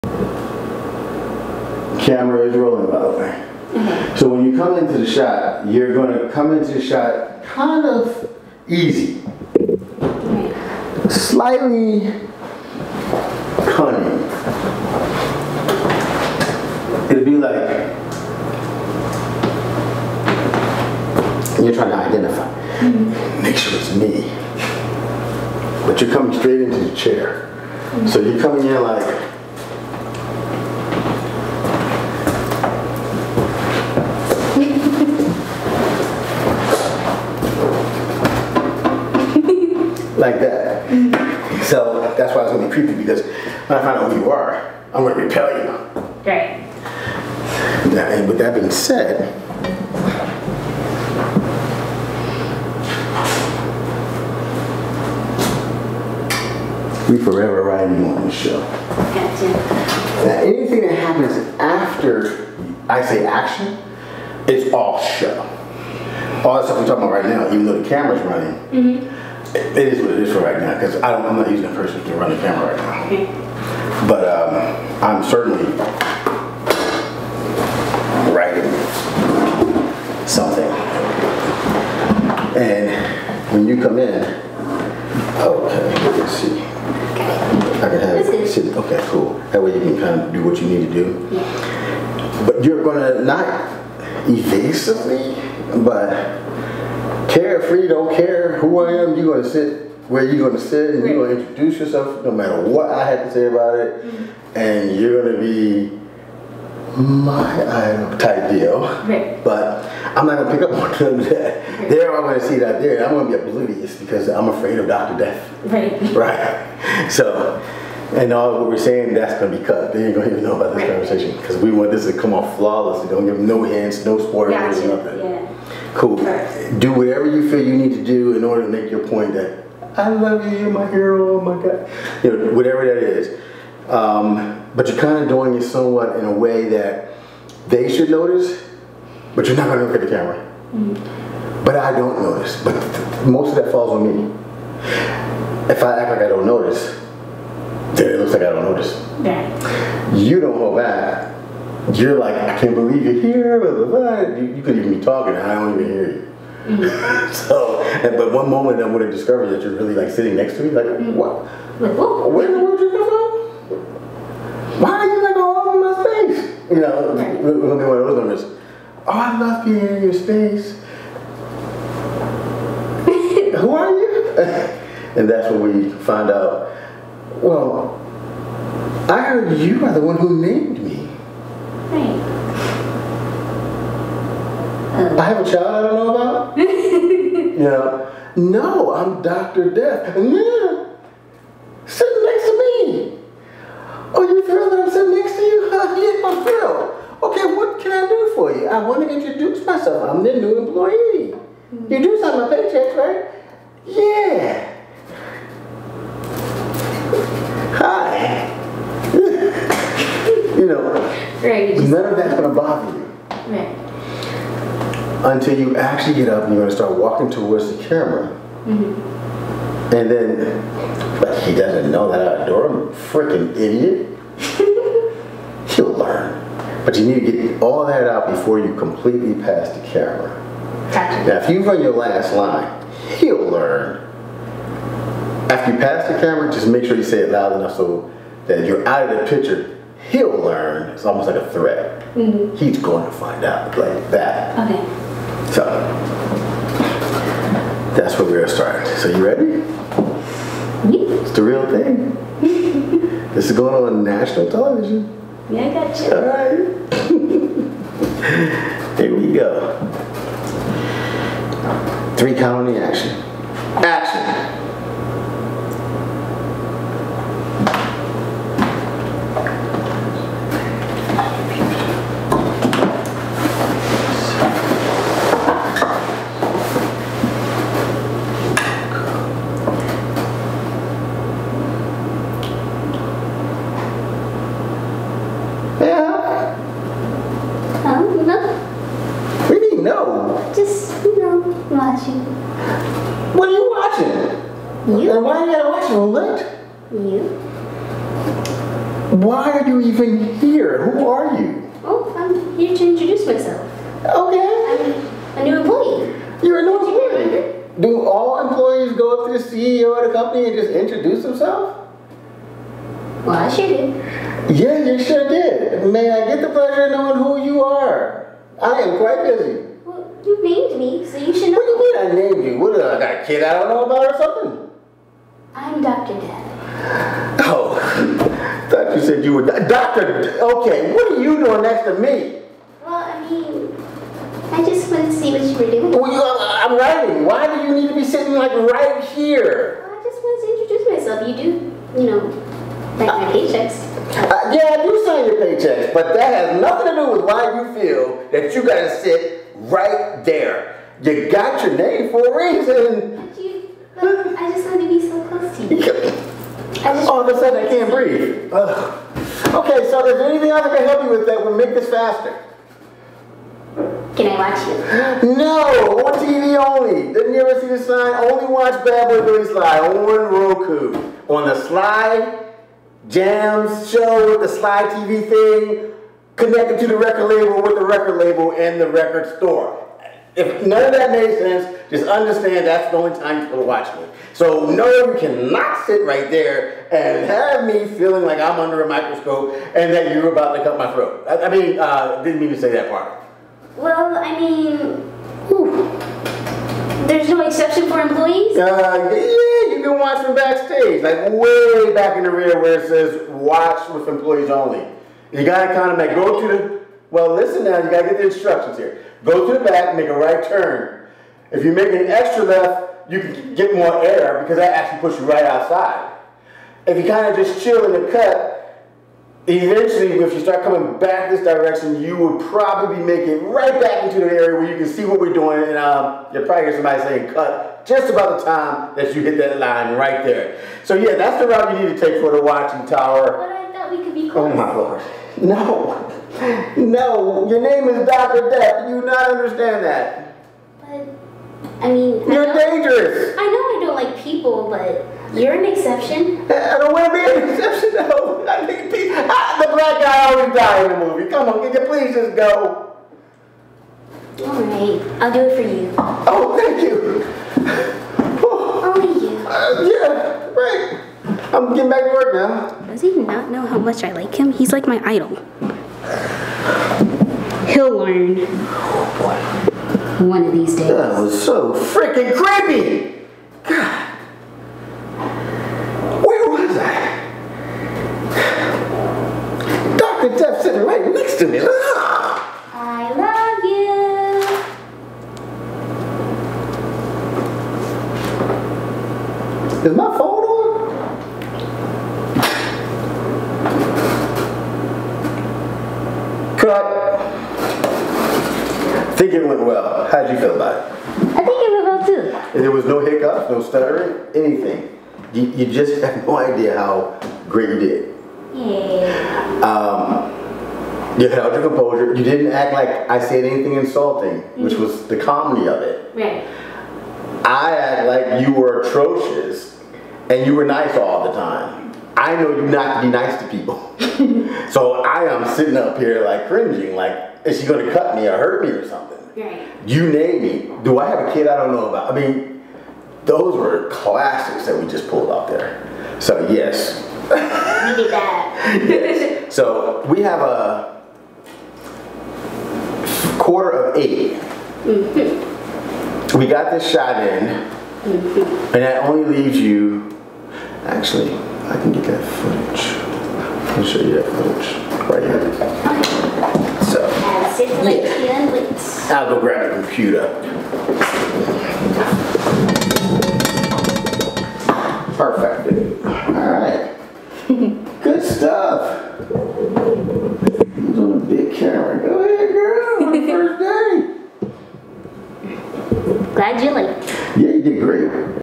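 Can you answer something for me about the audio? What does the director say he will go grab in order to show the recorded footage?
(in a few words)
a computer.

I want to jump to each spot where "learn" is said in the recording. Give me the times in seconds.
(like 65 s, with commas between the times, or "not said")
225 s, 233 s, 240 s, 467 s.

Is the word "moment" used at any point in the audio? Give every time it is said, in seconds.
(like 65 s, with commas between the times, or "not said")
158 s, 168 s.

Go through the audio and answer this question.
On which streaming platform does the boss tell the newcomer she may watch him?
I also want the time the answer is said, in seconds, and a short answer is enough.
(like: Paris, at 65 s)
Roku, at 370 s.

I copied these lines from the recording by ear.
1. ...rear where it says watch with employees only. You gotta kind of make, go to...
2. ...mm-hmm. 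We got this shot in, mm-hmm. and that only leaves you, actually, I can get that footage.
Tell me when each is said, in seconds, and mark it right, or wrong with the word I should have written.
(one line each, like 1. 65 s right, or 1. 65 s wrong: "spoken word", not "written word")
1. 402 s right
2. 544 s right.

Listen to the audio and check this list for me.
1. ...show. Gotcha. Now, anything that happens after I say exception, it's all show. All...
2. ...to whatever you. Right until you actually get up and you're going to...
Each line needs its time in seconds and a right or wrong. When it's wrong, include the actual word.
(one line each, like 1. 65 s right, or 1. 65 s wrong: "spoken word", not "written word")
1. 58 s wrong: "action", not "exception"
2. 212 s wrong: "bother", not "whatever".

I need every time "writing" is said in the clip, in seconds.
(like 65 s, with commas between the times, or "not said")
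78 s, 336 s.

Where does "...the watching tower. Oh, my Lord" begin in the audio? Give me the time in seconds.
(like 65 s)
432 s.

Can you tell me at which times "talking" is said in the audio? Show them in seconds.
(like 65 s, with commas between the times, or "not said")
66 s, 155 s.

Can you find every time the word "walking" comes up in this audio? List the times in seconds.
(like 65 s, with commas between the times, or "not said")
216 s.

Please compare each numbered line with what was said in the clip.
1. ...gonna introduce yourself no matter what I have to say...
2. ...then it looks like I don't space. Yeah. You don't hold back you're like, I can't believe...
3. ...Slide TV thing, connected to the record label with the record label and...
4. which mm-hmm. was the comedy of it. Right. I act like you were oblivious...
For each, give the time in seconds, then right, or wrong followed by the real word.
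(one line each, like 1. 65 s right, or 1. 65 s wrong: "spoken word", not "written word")
1. 101 s right
2. 147 s wrong: "notice", not "space"
3. 374 s right
4. 514 s wrong: "atrocious", not "oblivious".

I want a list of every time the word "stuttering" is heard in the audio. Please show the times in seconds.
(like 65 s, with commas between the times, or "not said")
503 s.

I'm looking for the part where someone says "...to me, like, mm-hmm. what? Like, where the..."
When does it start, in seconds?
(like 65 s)
160 s.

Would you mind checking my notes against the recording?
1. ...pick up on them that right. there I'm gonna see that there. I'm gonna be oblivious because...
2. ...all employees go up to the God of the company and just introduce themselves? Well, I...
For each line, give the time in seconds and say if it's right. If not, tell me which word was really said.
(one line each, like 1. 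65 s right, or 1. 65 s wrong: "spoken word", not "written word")
1. 110 s right
2. 308 s wrong: "CEO", not "God".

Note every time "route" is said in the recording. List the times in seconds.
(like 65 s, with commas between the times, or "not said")
431 s.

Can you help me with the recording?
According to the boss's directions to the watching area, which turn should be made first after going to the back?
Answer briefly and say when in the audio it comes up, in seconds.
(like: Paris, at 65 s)
right turn, at 409 s.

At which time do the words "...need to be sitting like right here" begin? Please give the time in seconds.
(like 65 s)
337 s.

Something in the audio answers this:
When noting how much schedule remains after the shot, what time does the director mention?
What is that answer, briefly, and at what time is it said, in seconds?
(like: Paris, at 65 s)
quarter of 8, at 540 s.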